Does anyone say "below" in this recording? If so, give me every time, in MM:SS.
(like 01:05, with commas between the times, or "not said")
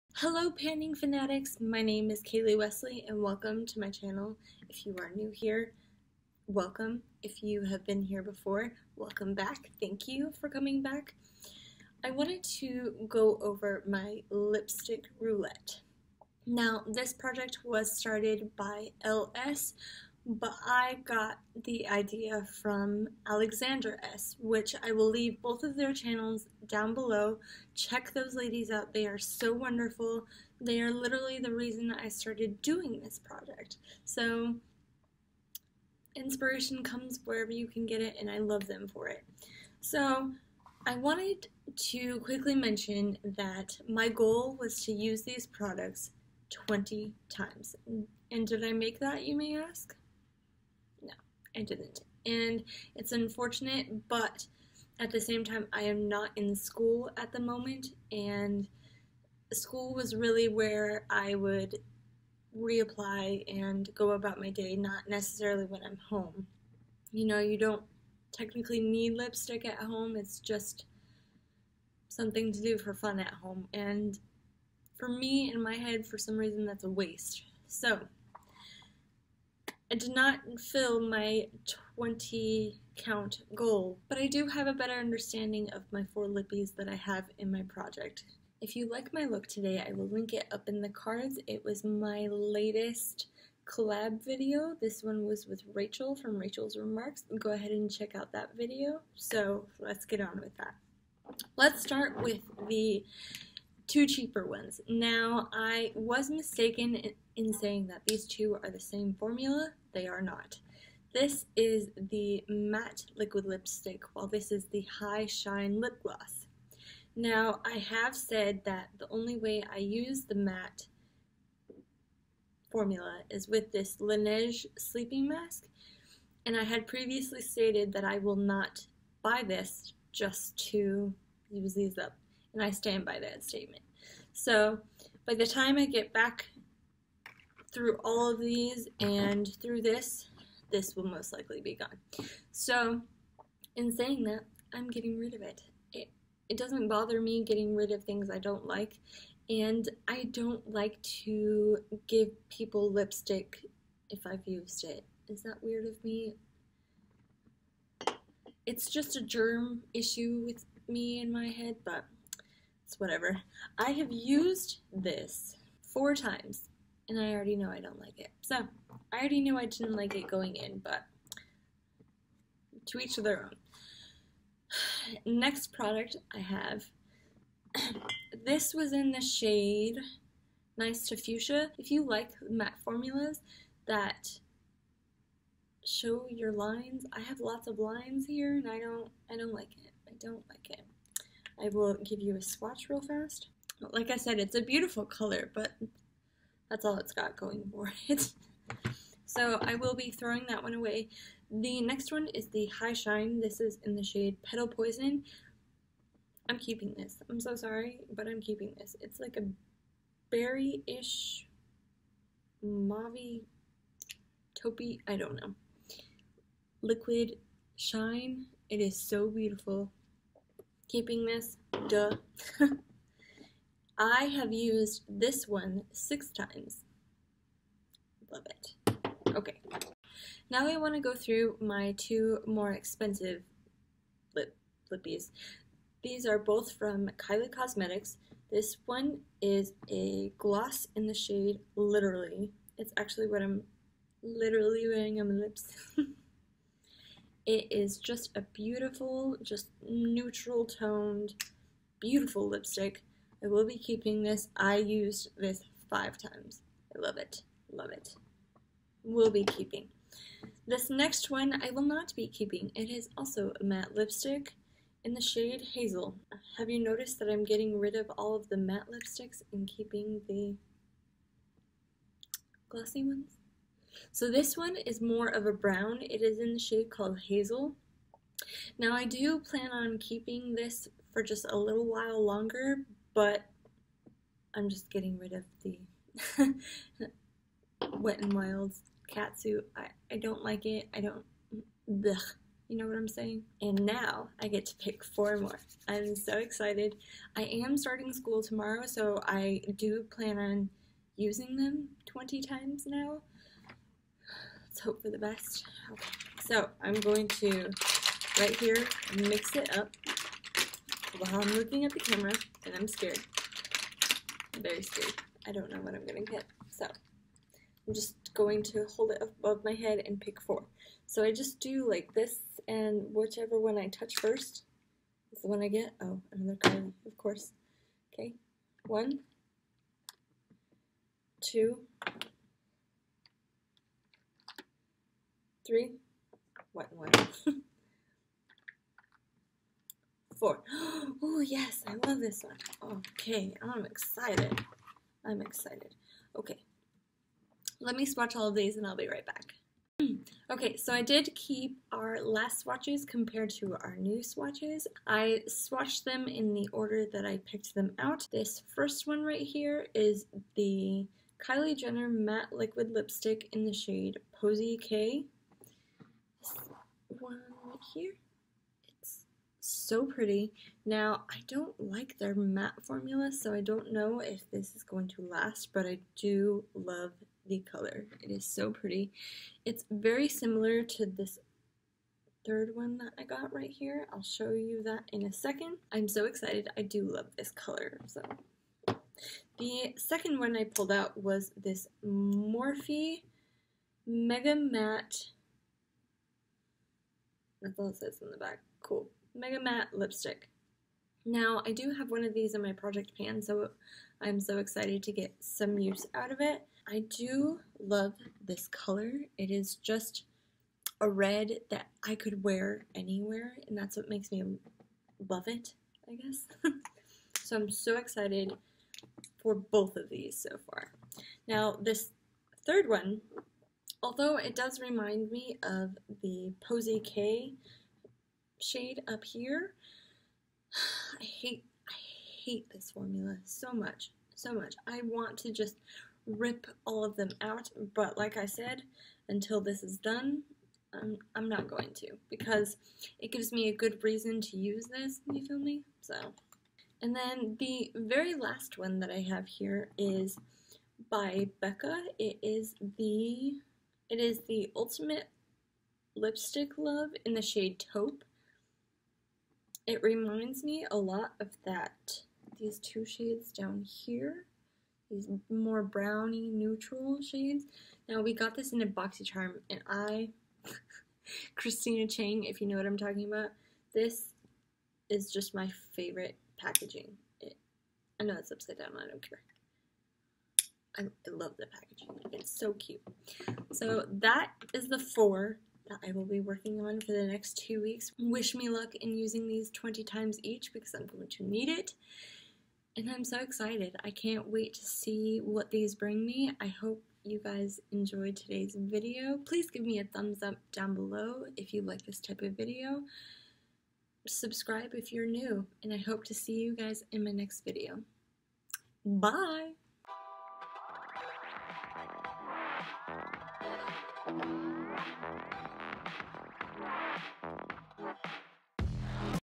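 00:26, 08:20.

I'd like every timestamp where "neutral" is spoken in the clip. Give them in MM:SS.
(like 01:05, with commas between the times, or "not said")
04:09, 07:46.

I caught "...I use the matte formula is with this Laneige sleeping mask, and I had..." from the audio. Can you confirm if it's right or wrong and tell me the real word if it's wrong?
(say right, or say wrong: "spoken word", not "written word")
right.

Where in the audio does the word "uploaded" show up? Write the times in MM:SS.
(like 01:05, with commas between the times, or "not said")
not said.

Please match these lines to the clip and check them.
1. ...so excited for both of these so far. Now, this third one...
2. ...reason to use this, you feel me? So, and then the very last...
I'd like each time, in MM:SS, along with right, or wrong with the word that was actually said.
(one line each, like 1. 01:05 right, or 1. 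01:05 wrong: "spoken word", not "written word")
1. 06:57 right
2. 07:24 right.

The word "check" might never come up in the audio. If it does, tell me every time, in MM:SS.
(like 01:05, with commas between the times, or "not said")
00:27, 01:37.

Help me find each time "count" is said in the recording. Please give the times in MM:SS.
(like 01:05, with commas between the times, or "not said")
01:22.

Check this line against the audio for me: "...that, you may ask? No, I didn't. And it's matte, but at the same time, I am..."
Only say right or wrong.
wrong.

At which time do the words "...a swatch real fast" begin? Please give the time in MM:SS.
03:12.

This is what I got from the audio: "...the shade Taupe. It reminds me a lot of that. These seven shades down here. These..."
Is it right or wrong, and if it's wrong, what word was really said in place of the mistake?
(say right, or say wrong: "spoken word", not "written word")
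wrong: "two", not "seven".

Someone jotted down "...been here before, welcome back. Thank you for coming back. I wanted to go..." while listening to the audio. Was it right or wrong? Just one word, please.
right.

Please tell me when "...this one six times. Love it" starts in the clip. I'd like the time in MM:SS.
03:45.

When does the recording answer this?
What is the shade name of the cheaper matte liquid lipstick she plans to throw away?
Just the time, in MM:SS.
03:00.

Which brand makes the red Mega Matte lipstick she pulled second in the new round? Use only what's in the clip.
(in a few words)
Morphe.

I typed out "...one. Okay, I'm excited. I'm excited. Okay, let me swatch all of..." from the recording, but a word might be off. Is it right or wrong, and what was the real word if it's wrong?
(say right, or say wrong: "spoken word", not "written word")
right.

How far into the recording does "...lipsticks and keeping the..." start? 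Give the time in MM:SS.
04:28.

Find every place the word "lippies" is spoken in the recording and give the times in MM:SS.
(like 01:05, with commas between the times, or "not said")
01:26, 03:54.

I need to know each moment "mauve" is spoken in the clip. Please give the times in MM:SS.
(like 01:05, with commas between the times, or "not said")
03:32.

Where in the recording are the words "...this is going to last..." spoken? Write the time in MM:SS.
06:14.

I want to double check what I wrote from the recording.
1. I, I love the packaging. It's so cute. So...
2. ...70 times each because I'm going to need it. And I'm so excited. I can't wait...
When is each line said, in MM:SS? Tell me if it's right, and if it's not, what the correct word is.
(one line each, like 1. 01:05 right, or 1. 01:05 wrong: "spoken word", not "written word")
1. 08:00 right
2. 08:09 wrong: "20", not "70".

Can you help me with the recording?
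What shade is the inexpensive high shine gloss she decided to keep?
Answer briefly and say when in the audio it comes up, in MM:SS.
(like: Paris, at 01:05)
Petal Poison, at 03:24.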